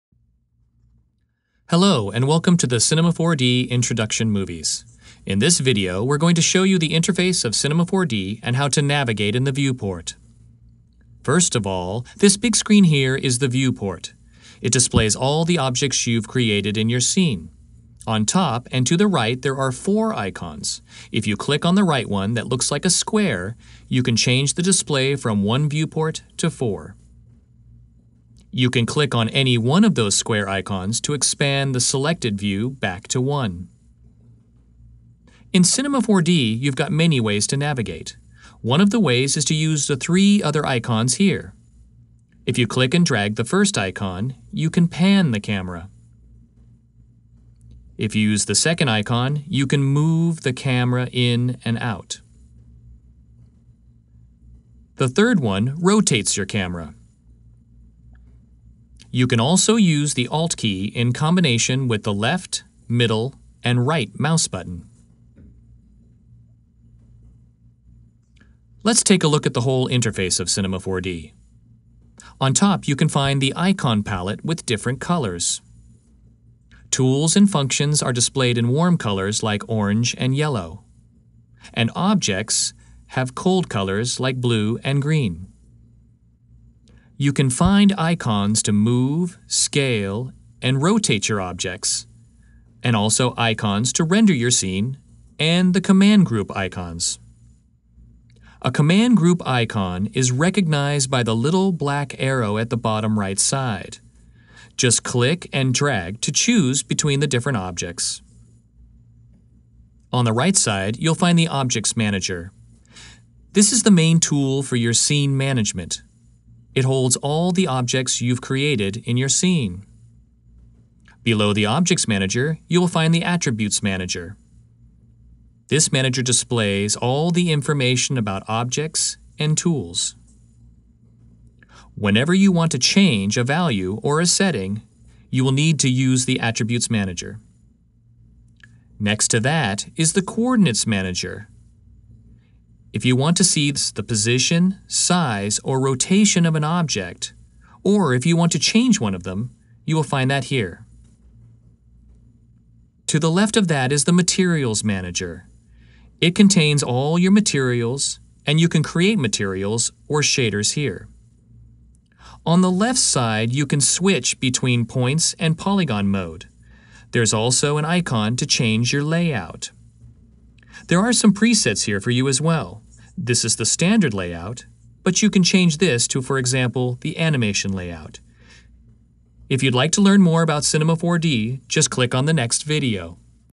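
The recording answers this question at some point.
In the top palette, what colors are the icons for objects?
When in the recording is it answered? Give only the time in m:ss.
1:24.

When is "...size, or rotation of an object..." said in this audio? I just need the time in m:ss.
2:24.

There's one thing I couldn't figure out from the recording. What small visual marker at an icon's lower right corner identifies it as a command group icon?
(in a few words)
little black arrow.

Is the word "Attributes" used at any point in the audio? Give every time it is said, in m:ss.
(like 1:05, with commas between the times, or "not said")
2:03, 2:16.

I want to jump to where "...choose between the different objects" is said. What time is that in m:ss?
1:46.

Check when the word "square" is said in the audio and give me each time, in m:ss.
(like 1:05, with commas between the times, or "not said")
0:22, 0:30.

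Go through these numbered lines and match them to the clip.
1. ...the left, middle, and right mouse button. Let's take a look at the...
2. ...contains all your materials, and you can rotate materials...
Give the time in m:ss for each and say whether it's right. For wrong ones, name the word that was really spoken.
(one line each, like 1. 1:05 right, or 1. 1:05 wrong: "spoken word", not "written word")
1. 1:02 right
2. 2:36 wrong: "create", not "rotate".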